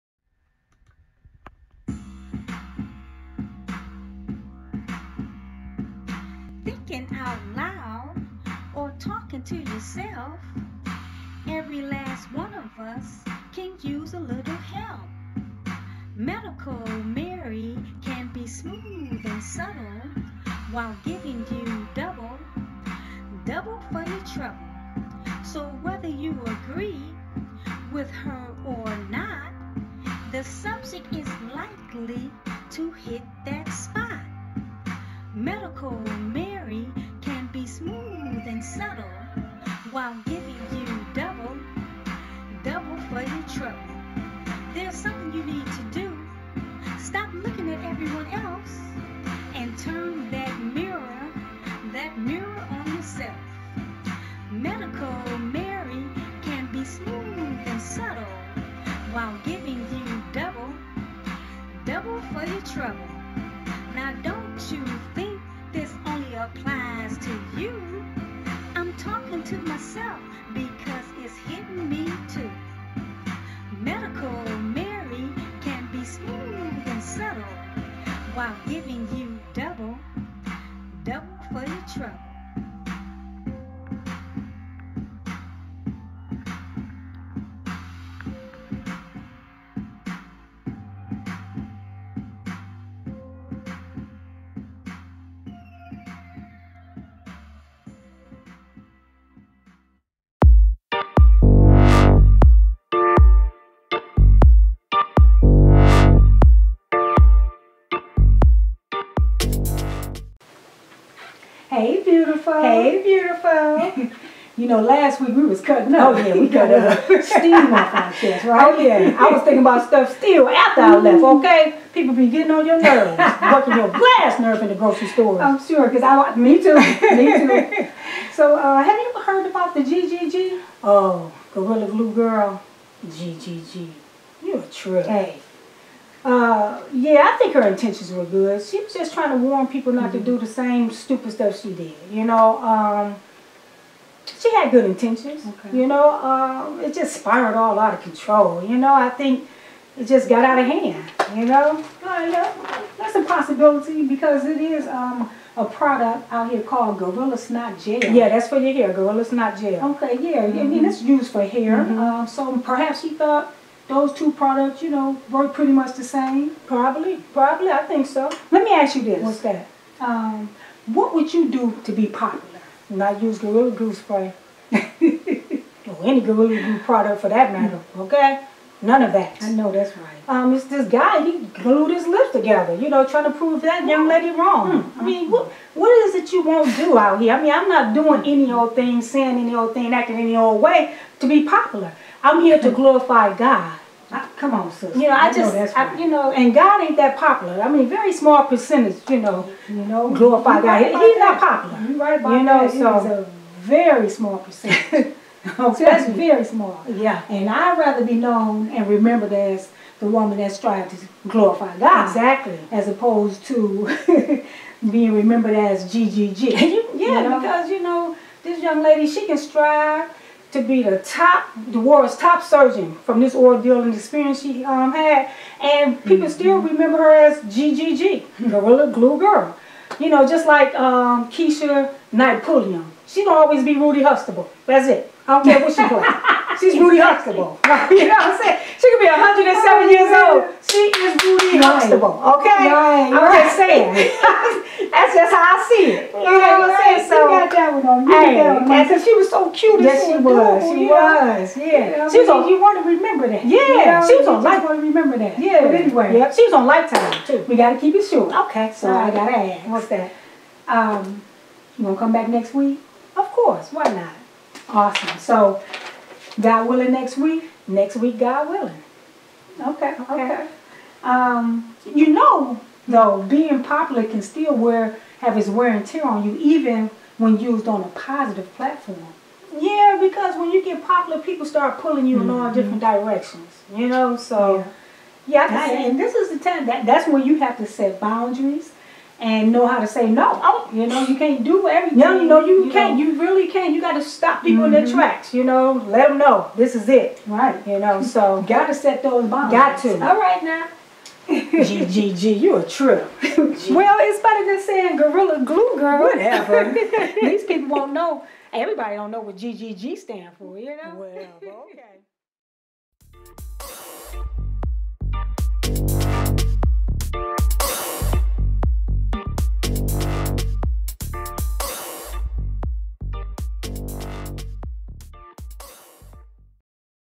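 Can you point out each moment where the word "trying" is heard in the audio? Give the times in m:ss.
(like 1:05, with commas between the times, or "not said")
2:19, 3:03, 3:30.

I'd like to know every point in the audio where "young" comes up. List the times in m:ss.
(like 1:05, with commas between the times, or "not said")
3:03, 3:38.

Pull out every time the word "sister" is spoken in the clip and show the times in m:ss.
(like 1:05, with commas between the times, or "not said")
3:14.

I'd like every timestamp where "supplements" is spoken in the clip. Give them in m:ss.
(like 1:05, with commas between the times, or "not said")
not said.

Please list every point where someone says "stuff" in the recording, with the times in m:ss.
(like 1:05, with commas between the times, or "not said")
1:59, 2:21.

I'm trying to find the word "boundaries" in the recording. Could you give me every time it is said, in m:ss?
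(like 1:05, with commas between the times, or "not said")
4:48, 4:59.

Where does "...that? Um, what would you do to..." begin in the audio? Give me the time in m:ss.
2:49.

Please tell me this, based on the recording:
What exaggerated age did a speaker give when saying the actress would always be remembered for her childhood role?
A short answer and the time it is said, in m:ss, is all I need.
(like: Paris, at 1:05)
107, at 3:59.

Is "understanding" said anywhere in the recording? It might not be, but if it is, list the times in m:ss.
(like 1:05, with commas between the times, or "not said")
not said.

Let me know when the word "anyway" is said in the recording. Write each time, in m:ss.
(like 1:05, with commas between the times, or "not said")
4:15.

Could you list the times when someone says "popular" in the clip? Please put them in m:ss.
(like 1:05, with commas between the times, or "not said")
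2:52, 3:11, 3:17, 3:21, 4:33, 4:40.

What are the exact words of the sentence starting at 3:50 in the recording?
You know, just like um, Keisha Napoleon.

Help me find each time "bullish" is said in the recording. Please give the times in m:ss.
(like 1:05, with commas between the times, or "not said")
not said.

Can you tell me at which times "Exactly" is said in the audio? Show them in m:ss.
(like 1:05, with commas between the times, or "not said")
3:32.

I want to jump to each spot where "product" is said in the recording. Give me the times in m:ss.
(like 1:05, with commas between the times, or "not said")
2:35, 2:44, 2:56.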